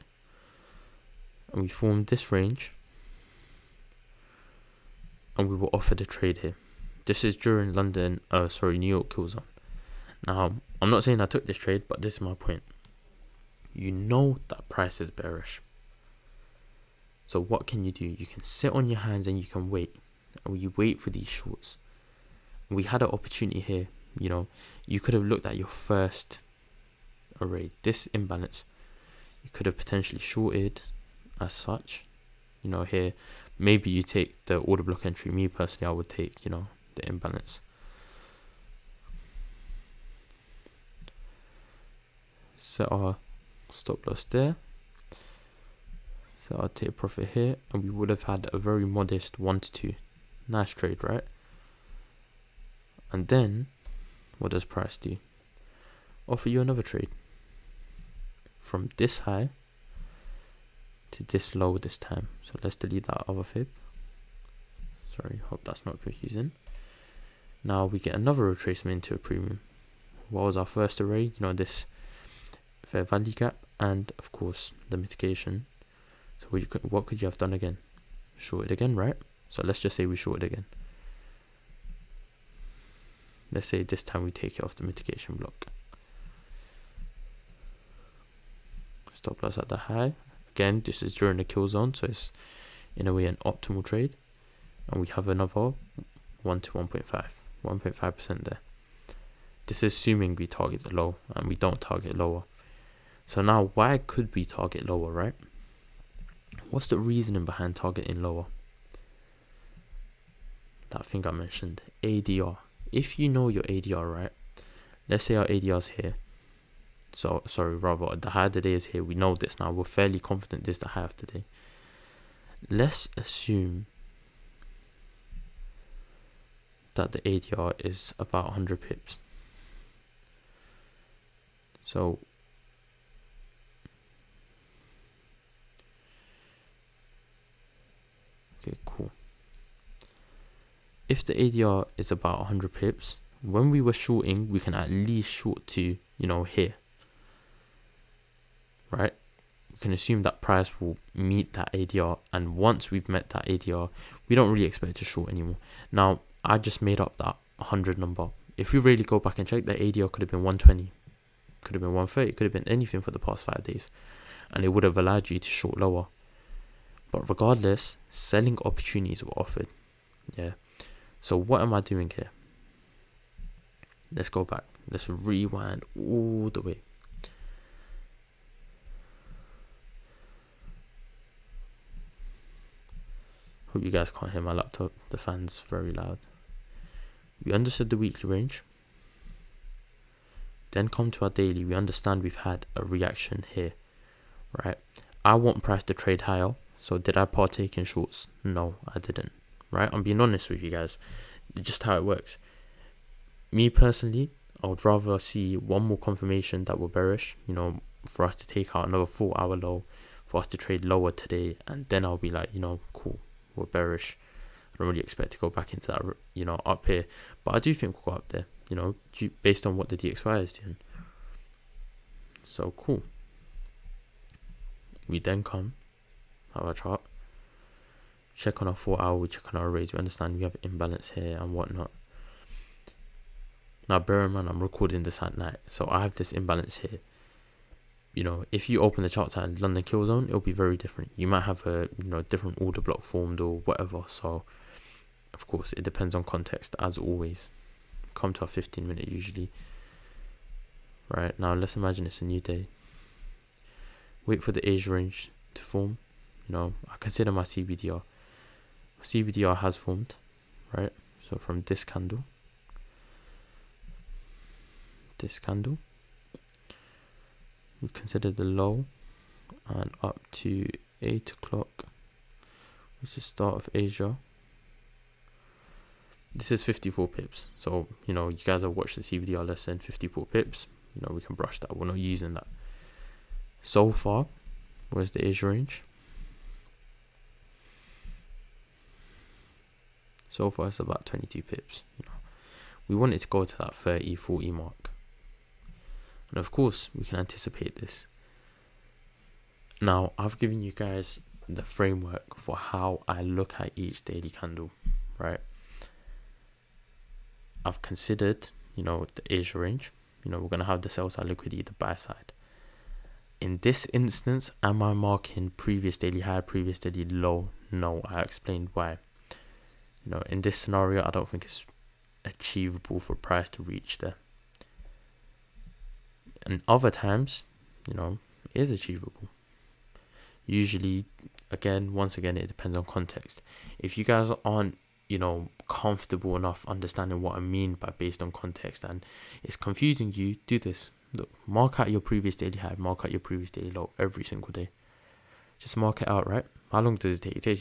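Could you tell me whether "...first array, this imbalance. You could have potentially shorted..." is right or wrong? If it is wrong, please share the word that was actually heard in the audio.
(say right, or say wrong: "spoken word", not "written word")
right.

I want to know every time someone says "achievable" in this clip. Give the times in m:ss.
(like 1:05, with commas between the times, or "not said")
5:22, 5:28.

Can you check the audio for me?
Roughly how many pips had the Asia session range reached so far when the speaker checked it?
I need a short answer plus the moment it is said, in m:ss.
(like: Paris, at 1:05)
22 pips, at 4:51.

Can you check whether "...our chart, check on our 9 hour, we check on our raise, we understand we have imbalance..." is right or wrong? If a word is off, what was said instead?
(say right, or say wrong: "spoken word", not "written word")
wrong: "4", not "9".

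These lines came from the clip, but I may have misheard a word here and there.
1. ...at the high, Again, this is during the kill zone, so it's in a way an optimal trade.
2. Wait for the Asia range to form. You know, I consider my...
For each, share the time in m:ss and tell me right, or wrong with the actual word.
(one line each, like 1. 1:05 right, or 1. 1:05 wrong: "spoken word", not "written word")
1. 1:29 right
2. 4:14 right.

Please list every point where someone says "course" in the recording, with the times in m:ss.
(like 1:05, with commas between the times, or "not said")
1:14, 4:05, 4:56.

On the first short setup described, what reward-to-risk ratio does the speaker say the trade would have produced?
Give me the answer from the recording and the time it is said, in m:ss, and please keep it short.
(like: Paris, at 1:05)
1 to 2, at 0:49.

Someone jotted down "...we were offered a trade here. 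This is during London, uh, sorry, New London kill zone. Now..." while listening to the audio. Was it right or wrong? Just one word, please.
wrong.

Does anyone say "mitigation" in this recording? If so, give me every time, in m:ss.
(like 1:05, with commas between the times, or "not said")
1:14, 1:24.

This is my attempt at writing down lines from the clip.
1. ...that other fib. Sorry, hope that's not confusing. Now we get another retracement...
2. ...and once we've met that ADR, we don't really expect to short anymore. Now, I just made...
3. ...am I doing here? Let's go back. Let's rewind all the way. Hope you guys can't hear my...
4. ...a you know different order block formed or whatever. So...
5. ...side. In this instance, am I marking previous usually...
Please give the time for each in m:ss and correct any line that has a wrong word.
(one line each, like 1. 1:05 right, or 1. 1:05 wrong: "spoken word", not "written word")
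1. 1:03 right
2. 2:32 right
3. 2:51 right
4. 4:01 right
5. 5:11 wrong: "daily", not "usually".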